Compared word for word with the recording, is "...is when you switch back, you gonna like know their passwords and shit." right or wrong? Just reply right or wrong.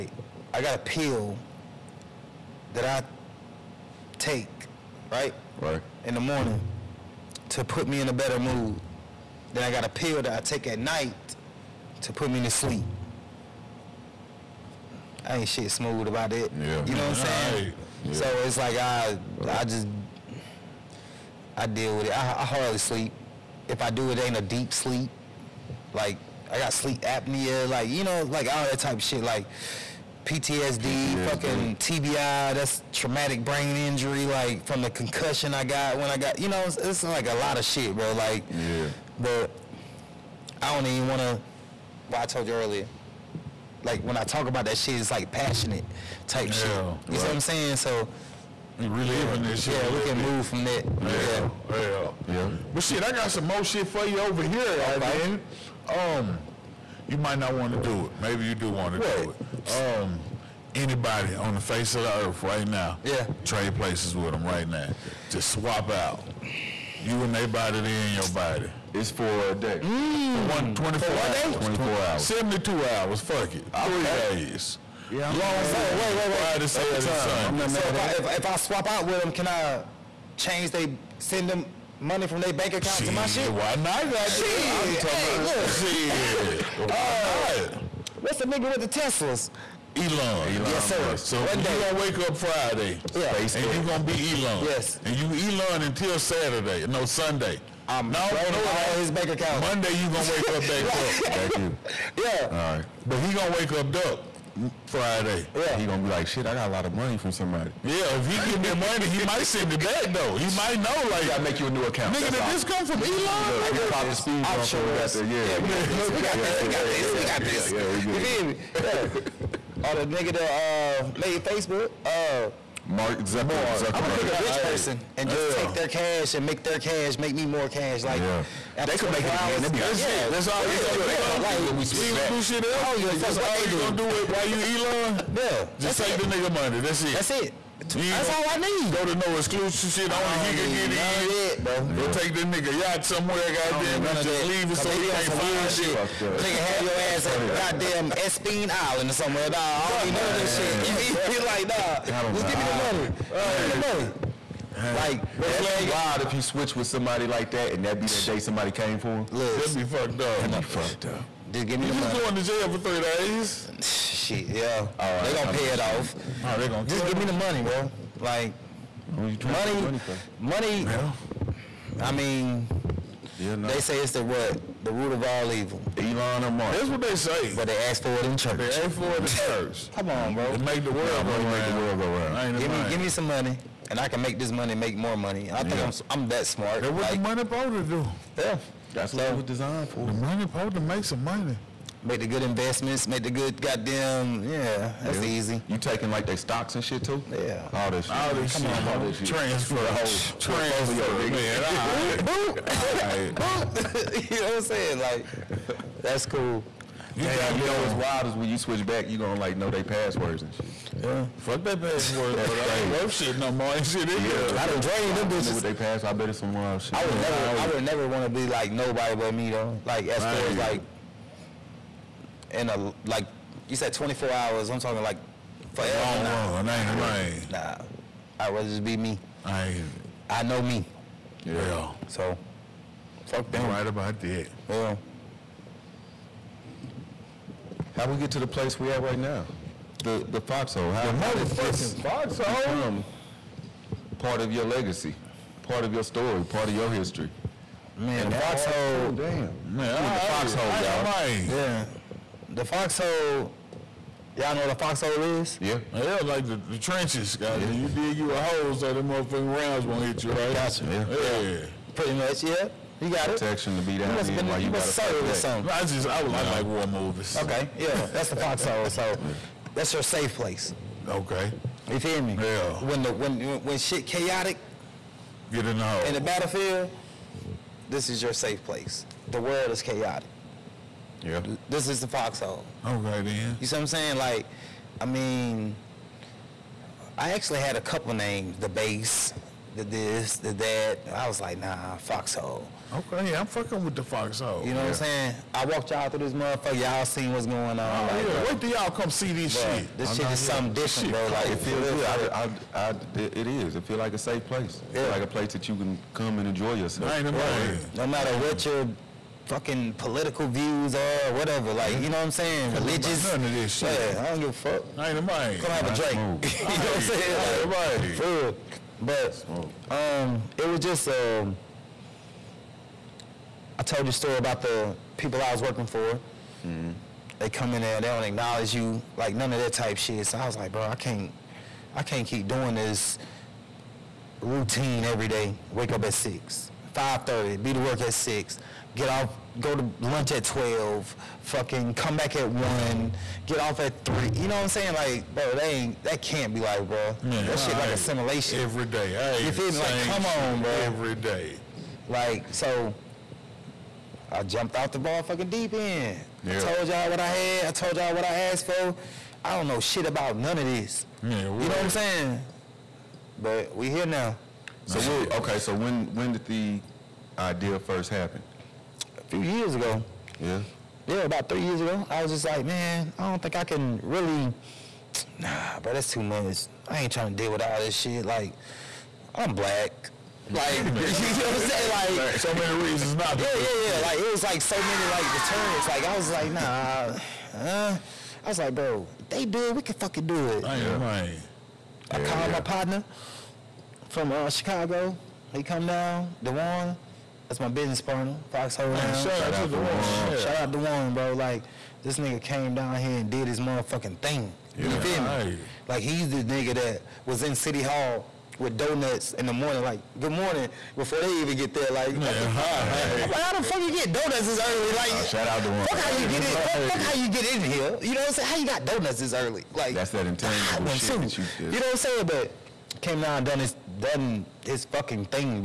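right.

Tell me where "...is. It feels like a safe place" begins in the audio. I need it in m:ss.
5:03.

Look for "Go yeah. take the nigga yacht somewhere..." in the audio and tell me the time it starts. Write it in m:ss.
2:21.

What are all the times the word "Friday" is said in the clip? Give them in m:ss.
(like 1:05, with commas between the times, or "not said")
1:16, 1:32, 1:44.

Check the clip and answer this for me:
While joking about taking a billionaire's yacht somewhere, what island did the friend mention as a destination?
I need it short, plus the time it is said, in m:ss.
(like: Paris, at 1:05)
Epstein Island, at 2:28.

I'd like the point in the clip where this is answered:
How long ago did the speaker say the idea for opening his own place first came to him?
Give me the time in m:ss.
6:11.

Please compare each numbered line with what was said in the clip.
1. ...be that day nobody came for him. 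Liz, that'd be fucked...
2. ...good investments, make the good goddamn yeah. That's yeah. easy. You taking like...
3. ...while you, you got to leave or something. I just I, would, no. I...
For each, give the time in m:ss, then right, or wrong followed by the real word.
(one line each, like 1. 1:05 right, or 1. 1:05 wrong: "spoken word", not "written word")
1. 2:37 wrong: "somebody", not "nobody"
2. 3:12 right
3. 4:24 wrong: "serve", not "leave".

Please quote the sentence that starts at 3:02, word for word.
Give me, give me some money and I can make this money, make more money.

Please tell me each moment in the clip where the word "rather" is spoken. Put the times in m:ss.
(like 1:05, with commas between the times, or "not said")
3:48.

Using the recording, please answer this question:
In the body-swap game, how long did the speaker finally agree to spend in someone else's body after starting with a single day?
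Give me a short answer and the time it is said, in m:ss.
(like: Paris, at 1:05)
72 hours, at 1:12.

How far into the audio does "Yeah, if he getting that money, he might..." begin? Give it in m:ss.
1:47.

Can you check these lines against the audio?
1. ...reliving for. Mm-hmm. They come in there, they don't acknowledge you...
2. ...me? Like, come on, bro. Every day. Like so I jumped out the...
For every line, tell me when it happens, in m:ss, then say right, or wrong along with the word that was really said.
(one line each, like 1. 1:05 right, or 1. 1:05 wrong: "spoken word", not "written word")
1. 5:25 wrong: "working", not "reliving"
2. 5:49 right.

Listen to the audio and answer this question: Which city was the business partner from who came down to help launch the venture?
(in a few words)
Chicago.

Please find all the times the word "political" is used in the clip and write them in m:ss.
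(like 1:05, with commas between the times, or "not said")
5:09.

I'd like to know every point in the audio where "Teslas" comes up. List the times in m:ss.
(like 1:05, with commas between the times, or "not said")
1:28.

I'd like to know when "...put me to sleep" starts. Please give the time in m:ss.
0:12.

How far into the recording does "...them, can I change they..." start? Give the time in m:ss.
1:19.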